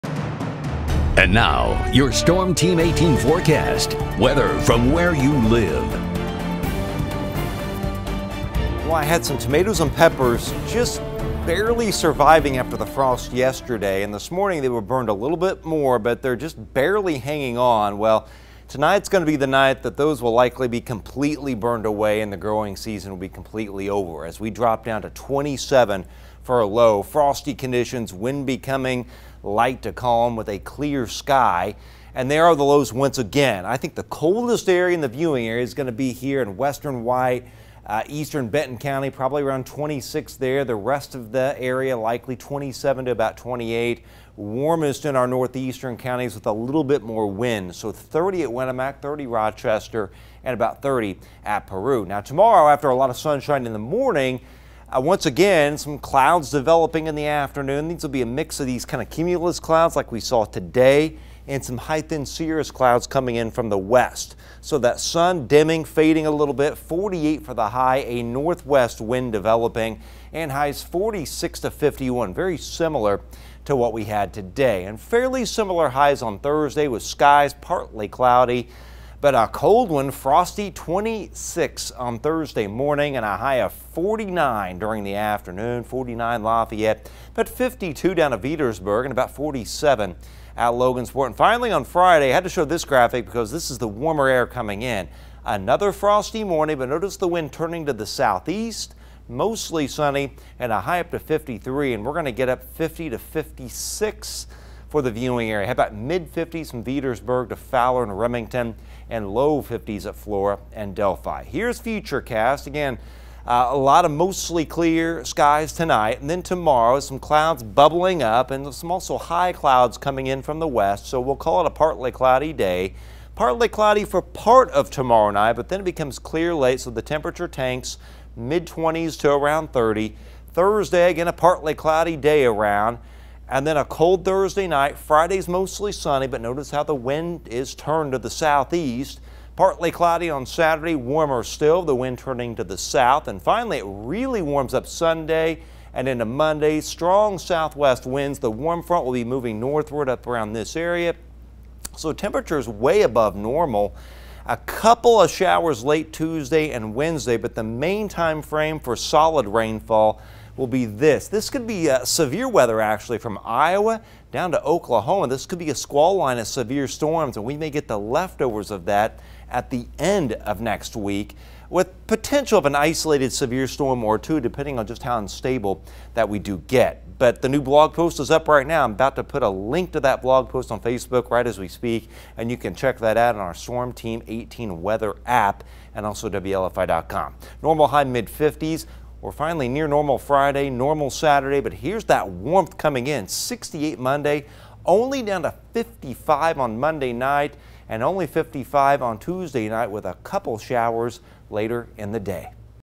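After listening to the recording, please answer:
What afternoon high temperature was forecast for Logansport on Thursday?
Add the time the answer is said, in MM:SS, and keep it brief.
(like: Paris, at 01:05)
47, at 01:29.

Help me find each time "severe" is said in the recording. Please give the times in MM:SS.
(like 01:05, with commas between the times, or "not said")
02:42, 02:46, 02:53.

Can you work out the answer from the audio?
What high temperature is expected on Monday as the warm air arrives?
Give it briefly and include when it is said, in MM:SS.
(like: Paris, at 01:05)
68, at 03:13.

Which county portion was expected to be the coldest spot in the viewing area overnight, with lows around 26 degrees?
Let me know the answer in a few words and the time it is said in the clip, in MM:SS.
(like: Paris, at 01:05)
Eastern Benton County, at 00:38.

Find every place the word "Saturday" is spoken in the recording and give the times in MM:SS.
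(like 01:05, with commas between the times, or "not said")
02:20, 03:11.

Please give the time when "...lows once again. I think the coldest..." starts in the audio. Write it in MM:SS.
00:32.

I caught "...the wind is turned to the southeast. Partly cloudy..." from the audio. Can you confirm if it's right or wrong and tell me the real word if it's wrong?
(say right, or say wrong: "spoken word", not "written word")
right.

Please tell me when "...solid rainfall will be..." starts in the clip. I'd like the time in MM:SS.
02:38.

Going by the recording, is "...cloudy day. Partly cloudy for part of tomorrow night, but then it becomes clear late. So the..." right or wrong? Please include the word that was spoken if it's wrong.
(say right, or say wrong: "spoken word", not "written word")
right.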